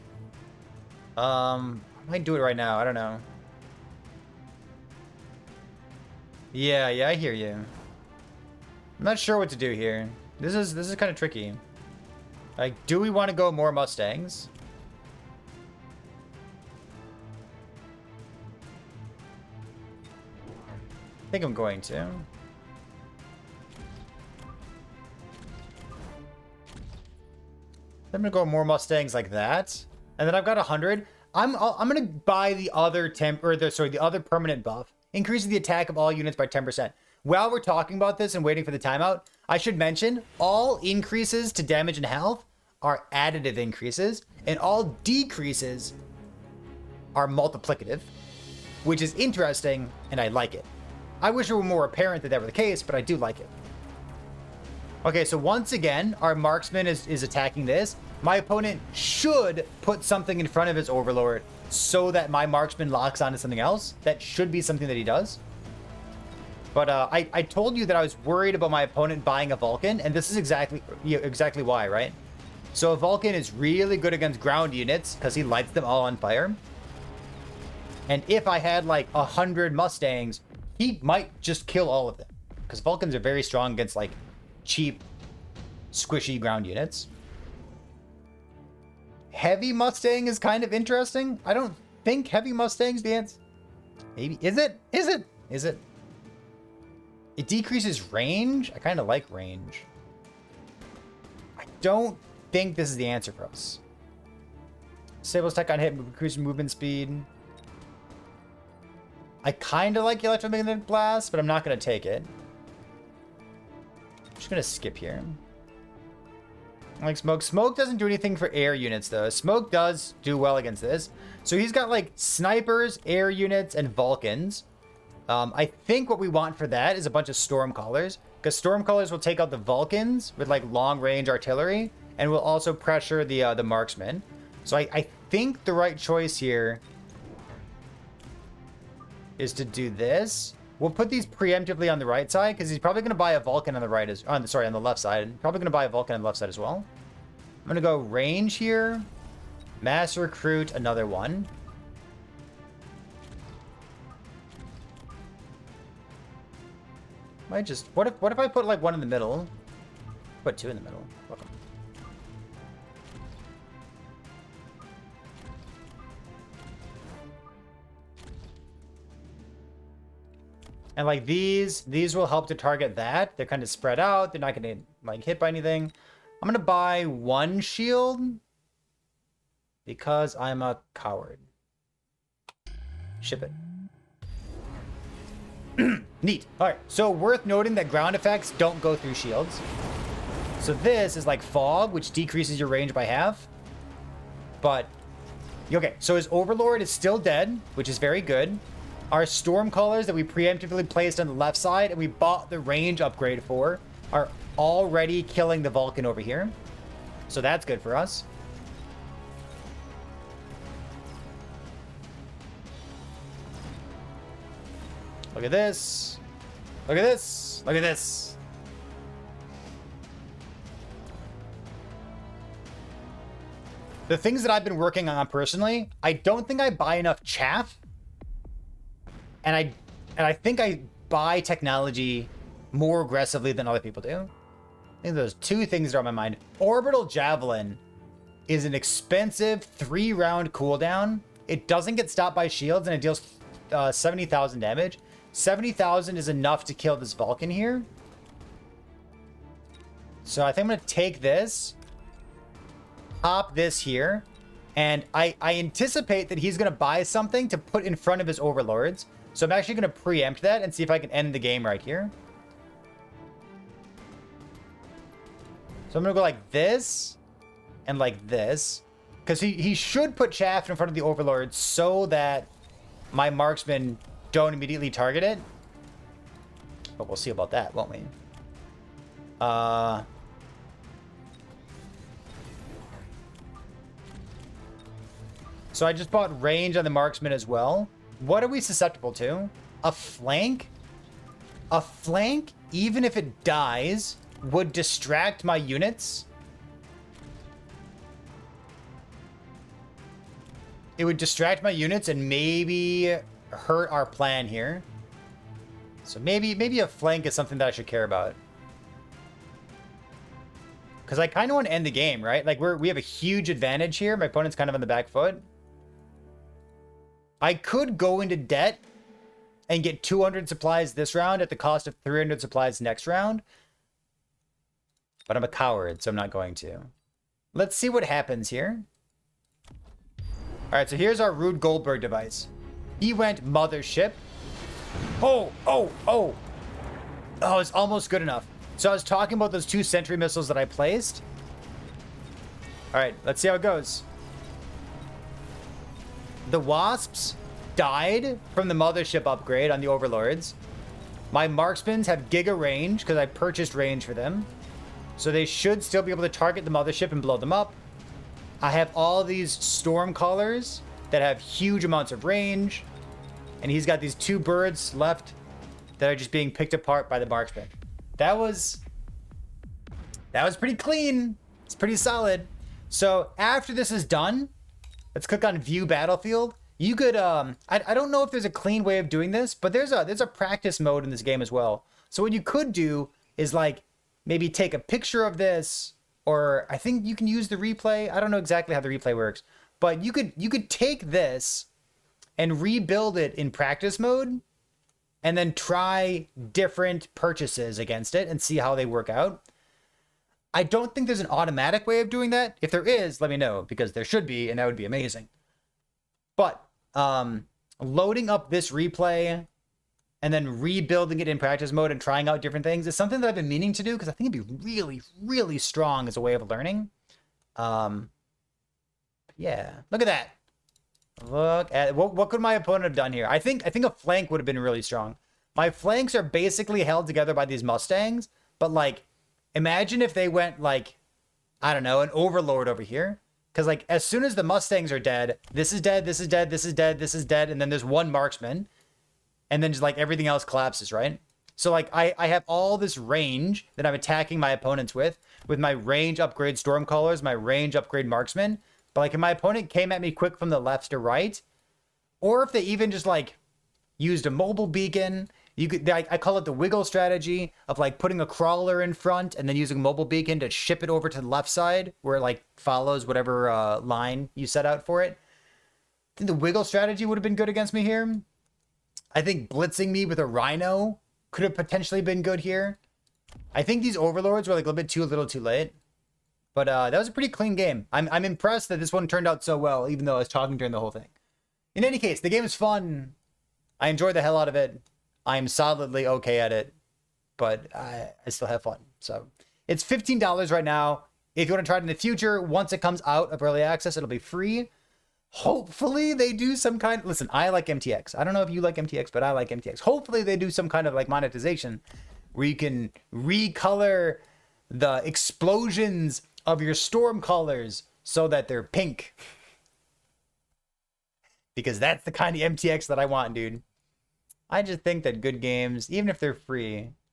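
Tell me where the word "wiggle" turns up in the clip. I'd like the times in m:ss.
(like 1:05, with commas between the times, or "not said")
7:36, 7:46.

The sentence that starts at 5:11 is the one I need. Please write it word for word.
Because I kind of want to end the game, right?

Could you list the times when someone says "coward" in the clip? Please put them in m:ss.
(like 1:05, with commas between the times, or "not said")
3:00, 5:25.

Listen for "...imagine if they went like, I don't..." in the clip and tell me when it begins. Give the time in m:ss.
7:09.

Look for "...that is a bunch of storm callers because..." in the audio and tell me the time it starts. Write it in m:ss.
2:06.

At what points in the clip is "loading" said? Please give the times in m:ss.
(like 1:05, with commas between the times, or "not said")
6:47.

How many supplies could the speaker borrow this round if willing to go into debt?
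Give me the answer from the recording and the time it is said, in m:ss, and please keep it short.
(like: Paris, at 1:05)
200, at 5:20.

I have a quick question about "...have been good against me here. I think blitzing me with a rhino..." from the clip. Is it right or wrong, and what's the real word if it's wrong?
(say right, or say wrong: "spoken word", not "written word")
right.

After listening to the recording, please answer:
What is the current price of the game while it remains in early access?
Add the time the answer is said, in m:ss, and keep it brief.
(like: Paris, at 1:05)
$15, at 8:09.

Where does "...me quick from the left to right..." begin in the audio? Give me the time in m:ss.
7:30.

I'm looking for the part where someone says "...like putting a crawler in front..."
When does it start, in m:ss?
7:37.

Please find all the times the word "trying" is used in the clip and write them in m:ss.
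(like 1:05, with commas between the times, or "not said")
6:52.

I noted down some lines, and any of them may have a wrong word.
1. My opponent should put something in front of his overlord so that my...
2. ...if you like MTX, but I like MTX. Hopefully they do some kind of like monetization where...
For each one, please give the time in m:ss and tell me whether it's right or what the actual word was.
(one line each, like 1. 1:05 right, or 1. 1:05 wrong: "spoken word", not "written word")
1. 0:58 right
2. 8:18 right.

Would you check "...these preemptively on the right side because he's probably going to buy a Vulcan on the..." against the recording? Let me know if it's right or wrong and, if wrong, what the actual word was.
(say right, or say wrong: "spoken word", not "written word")
right.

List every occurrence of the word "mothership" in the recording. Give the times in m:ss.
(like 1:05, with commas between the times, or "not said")
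5:33, 5:48, 5:56.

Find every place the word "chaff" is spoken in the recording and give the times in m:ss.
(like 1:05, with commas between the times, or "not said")
3:47, 4:30.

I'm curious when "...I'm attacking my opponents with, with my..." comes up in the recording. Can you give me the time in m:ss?
7:23.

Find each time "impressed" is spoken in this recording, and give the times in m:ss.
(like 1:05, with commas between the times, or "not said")
7:58.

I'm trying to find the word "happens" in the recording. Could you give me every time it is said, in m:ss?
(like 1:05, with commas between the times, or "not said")
5:28.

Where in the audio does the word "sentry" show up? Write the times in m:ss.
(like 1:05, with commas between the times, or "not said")
5:39.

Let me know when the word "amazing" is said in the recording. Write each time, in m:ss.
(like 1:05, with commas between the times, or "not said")
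6:44.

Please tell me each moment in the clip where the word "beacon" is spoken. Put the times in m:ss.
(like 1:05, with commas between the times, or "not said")
7:34, 7:40.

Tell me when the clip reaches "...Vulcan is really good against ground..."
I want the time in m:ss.
1:13.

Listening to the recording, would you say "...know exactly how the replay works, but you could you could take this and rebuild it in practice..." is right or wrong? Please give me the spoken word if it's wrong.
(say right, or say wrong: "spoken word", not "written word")
right.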